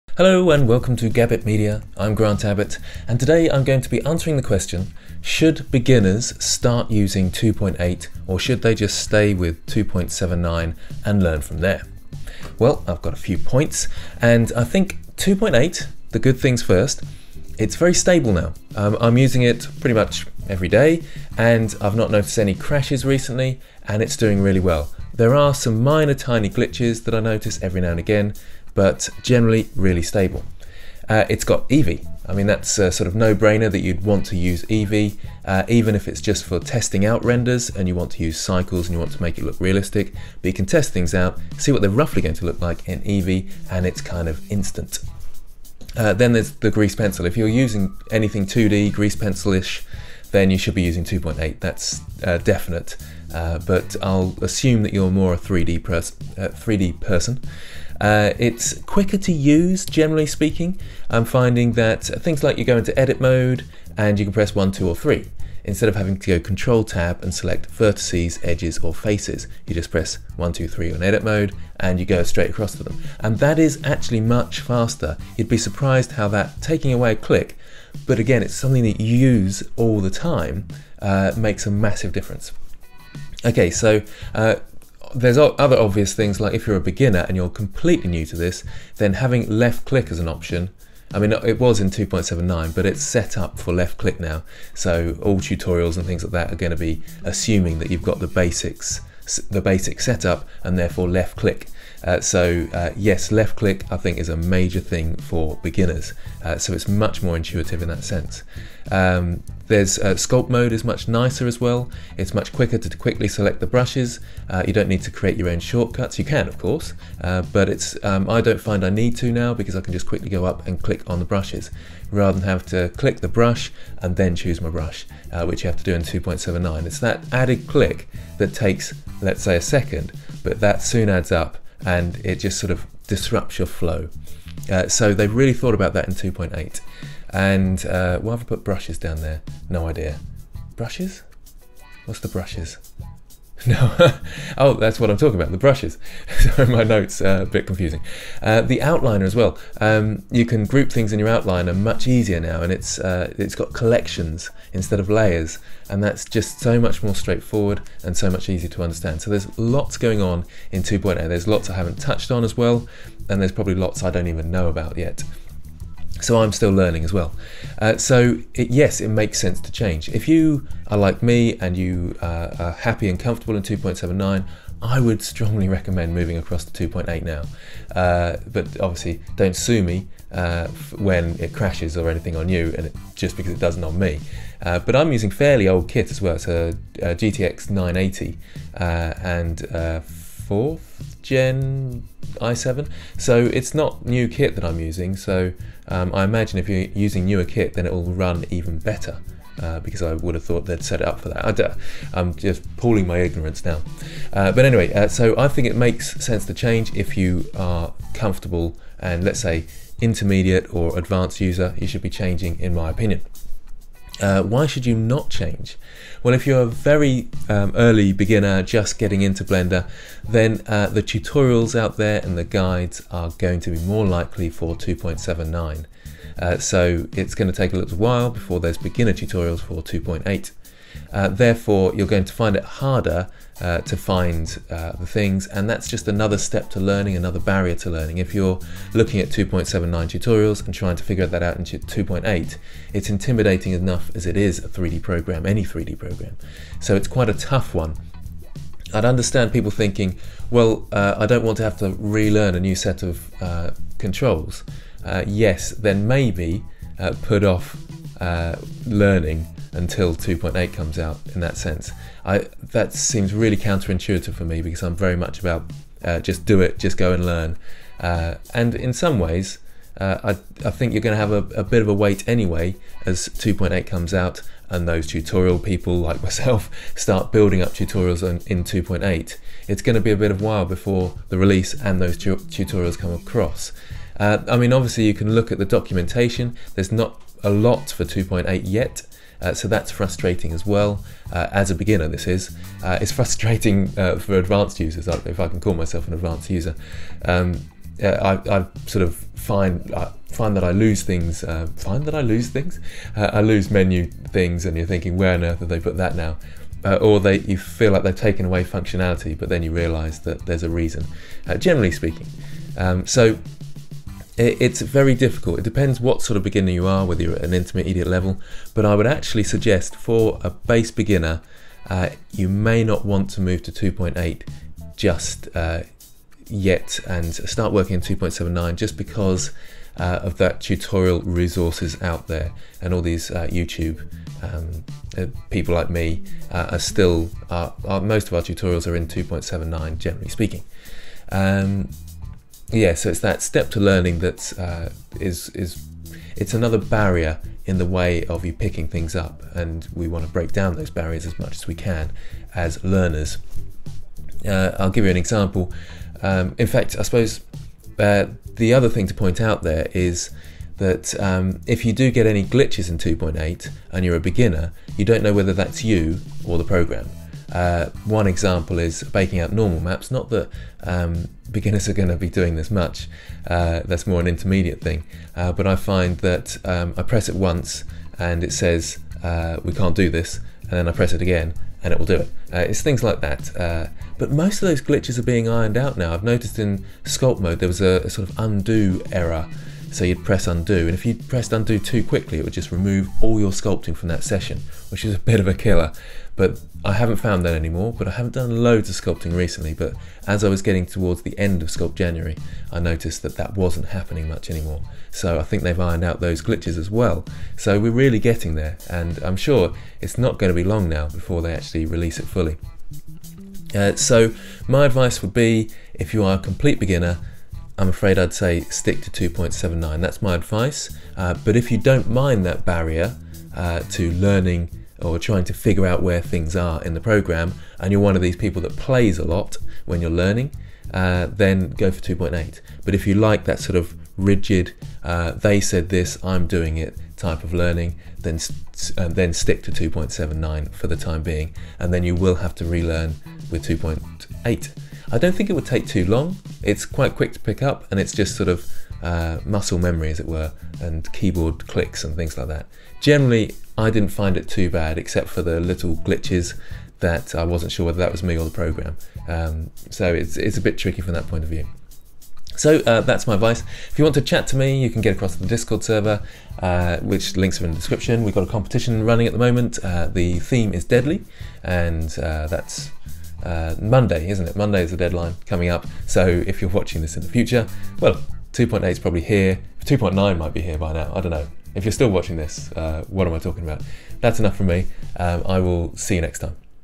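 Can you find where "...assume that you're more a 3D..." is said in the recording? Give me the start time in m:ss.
0:54.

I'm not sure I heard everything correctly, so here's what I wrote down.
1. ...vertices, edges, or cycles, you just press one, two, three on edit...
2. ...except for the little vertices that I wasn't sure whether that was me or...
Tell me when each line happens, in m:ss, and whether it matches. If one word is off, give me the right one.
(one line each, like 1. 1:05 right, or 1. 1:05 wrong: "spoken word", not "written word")
1. 1:07 wrong: "faces", not "cycles"
2. 7:34 wrong: "glitches", not "vertices".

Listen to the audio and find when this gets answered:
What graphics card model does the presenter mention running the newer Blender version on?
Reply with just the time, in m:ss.
3:07.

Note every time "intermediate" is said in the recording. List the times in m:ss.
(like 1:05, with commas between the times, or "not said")
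3:29, 5:17, 6:14.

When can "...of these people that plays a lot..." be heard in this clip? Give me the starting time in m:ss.
7:08.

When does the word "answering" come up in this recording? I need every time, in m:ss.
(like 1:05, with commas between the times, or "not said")
0:04.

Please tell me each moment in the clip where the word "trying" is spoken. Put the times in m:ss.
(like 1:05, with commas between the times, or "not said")
4:00, 7:05.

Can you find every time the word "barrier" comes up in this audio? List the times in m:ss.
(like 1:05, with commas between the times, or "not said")
3:57, 5:46, 5:50, 7:02.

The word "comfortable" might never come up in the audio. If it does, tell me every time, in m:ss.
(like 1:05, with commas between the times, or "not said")
2:53, 3:28.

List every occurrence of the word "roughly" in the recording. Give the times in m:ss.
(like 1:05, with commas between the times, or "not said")
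0:41.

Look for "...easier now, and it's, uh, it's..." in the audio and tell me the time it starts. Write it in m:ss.
2:32.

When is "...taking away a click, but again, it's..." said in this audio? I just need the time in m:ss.
1:16.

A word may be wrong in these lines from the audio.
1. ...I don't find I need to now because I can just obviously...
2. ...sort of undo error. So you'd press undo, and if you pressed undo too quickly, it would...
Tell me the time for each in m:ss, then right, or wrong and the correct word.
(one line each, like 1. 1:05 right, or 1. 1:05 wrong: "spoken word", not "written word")
1. 1:58 wrong: "quickly", not "obviously"
2. 6:28 right.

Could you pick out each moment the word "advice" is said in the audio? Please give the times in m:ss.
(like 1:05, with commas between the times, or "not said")
6:54, 7:00, 7:43.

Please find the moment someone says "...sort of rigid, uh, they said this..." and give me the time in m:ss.
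7:13.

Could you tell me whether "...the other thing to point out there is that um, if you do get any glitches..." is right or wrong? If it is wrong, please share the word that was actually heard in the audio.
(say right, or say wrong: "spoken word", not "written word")
right.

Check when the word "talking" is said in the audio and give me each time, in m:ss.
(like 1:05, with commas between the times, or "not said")
2:25, 8:03.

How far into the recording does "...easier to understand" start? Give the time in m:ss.
2:38.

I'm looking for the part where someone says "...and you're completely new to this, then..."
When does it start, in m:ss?
1:27.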